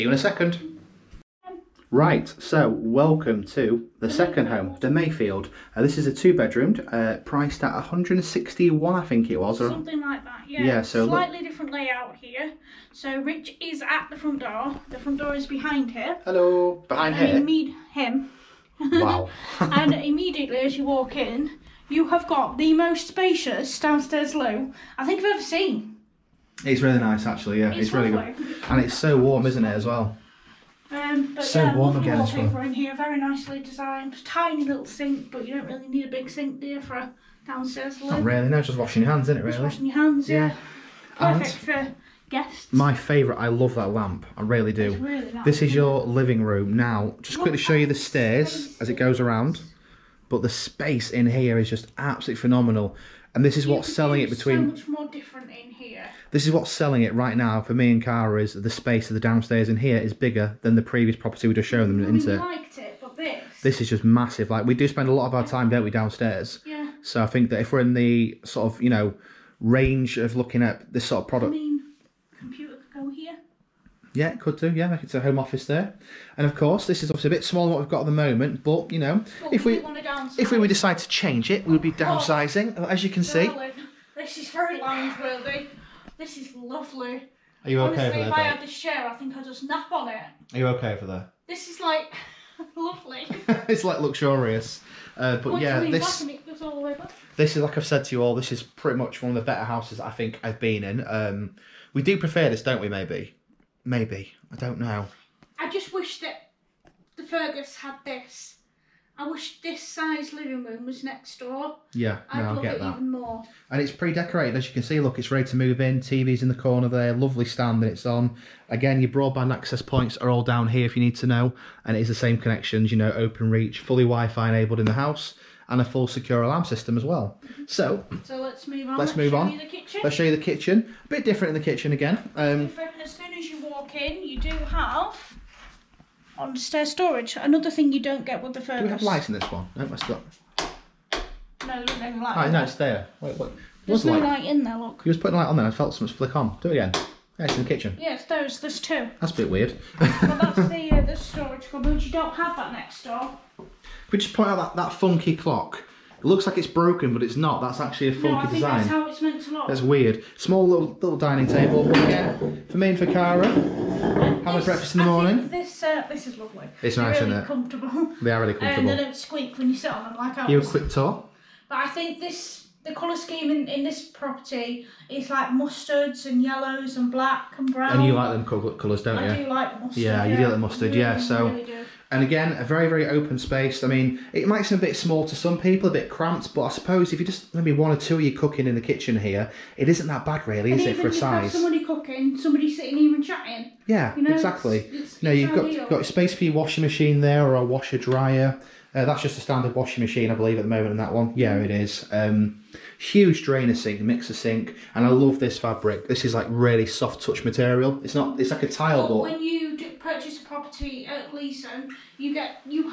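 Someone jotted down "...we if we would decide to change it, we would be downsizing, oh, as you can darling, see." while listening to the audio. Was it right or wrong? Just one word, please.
right.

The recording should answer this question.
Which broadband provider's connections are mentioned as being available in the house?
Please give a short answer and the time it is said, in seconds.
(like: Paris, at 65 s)
Openreach, at 123 s.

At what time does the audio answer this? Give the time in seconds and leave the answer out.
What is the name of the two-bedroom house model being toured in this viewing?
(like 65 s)
4 s.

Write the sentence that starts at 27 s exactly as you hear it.
Yeah, it's, it's really good, and it's so warm, isn't it, as well?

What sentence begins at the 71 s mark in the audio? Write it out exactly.
I mean, computer could go here.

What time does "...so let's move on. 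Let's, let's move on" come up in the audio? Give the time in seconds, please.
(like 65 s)
128 s.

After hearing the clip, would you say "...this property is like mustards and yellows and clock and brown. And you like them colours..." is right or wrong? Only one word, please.
wrong.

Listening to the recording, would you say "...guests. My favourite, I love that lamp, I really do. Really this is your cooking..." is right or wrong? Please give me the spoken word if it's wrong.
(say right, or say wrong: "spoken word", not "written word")
wrong: "living", not "cooking".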